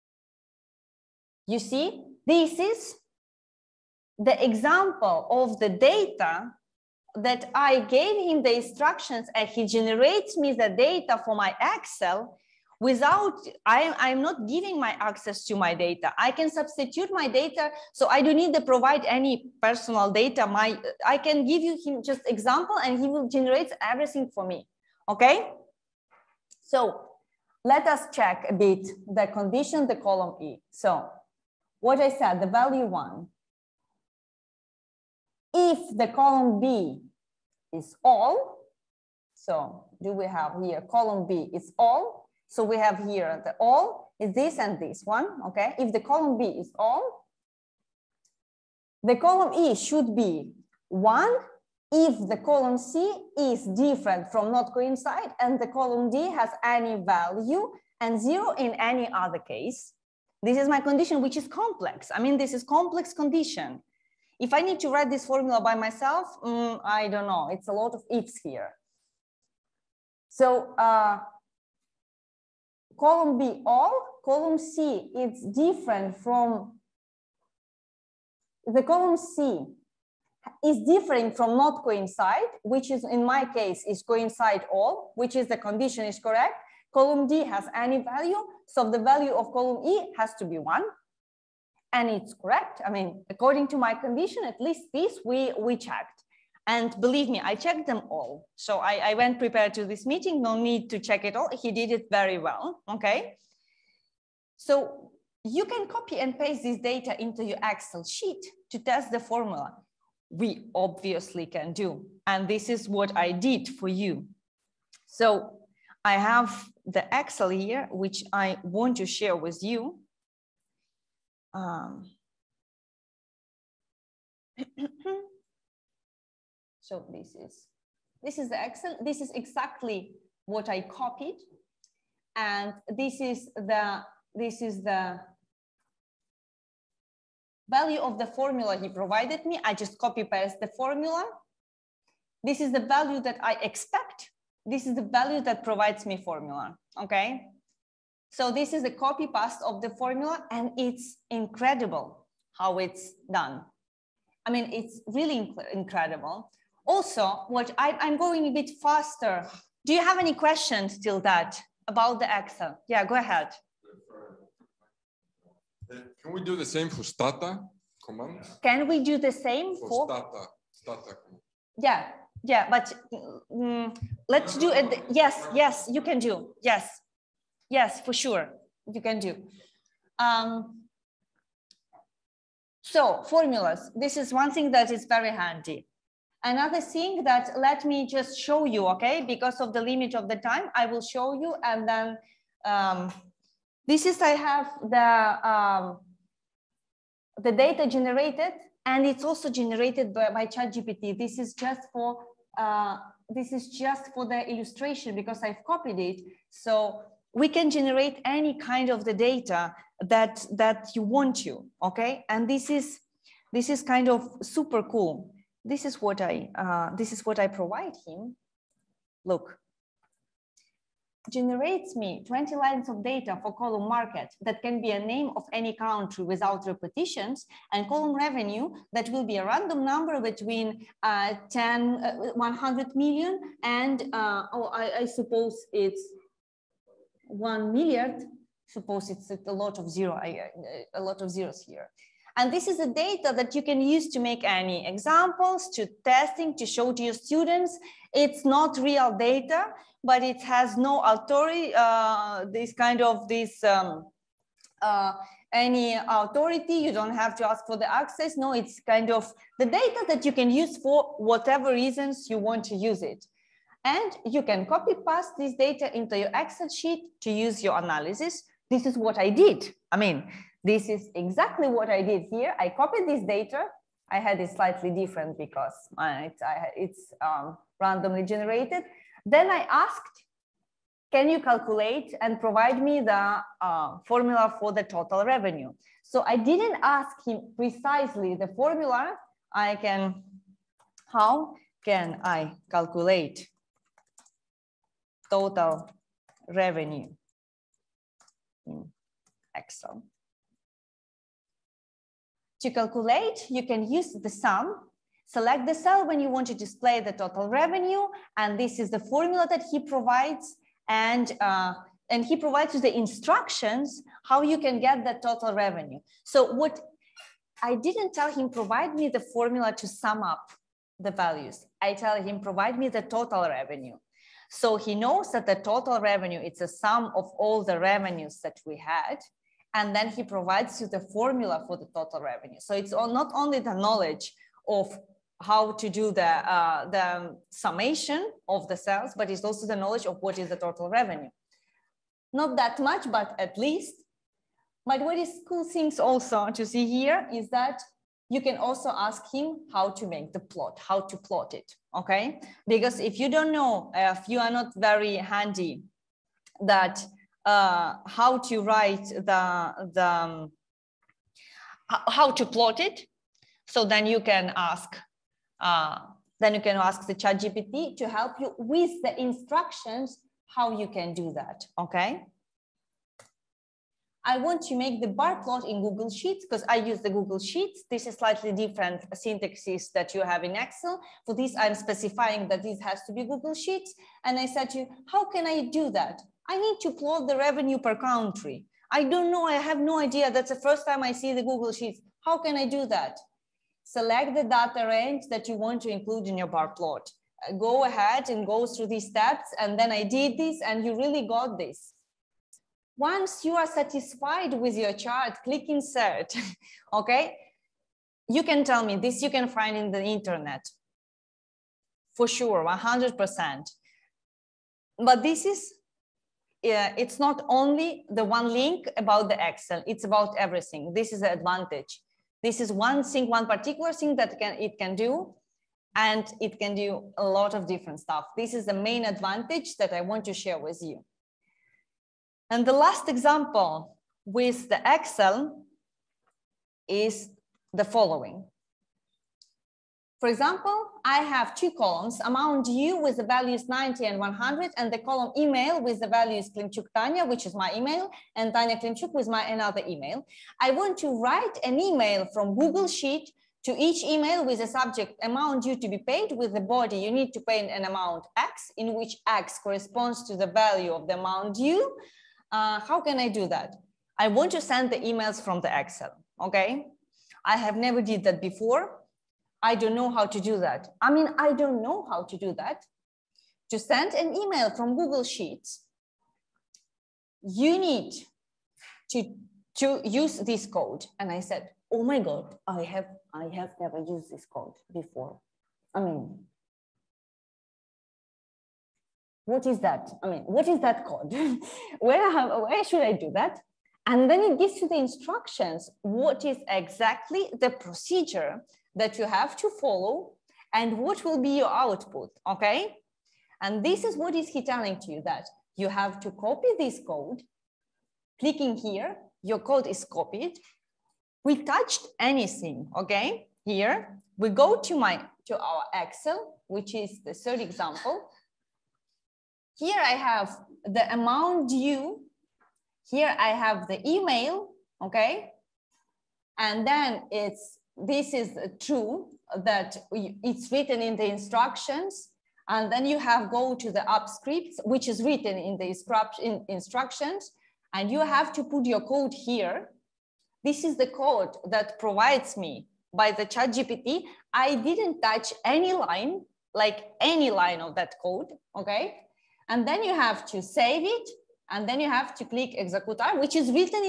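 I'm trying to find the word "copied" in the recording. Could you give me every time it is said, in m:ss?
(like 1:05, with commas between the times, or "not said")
2:10, 3:25, 4:32, 8:30.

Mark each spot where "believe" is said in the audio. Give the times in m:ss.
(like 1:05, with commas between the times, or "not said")
1:36.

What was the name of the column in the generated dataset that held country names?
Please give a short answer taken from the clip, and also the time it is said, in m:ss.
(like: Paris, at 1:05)
market, at 3:43.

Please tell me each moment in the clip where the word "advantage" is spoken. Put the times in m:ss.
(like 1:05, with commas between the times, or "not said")
7:01, 7:09.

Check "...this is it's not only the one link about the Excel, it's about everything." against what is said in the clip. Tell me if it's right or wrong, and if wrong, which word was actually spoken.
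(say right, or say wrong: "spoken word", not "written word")
right.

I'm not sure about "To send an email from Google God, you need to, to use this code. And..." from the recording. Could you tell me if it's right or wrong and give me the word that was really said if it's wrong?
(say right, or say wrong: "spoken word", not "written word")
wrong: "Sheets", not "God".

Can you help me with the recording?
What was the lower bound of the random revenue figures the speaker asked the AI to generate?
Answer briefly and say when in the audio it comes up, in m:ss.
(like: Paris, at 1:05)
100 million, at 3:52.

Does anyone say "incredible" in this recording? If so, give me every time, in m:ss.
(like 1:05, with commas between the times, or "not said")
2:31, 2:35.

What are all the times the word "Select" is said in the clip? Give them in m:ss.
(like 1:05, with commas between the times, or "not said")
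5:05, 6:33.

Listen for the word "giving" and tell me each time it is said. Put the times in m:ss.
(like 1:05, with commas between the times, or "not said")
0:14.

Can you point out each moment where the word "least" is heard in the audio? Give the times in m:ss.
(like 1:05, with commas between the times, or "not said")
1:34, 5:43.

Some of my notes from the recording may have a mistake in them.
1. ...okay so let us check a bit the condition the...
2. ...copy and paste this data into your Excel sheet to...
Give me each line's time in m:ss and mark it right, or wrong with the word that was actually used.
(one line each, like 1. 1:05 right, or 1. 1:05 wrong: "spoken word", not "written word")
1. 0:25 right
2. 1:45 right.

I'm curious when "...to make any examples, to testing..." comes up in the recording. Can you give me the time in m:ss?
4:04.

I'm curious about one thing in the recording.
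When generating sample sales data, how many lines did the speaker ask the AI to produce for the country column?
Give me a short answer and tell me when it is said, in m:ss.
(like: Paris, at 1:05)
20, at 3:42.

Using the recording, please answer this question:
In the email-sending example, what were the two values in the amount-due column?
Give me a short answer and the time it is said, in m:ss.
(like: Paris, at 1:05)
90 and 100, at 7:23.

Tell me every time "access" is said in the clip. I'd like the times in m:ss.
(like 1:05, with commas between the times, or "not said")
0:14, 4:17.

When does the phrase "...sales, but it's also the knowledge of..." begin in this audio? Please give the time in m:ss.
5:38.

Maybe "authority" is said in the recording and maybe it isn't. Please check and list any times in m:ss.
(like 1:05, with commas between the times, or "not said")
4:11, 4:15.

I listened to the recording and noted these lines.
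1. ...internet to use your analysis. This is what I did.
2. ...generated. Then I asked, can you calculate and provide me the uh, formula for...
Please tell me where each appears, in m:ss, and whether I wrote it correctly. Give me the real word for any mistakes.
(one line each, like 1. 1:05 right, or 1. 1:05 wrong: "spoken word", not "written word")
1. 4:26 wrong: "sheet", not "internet"
2. 4:38 right.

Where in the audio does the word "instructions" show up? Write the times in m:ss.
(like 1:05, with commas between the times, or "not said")
0:08, 5:12, 6:09, 8:14, 8:51, 8:56.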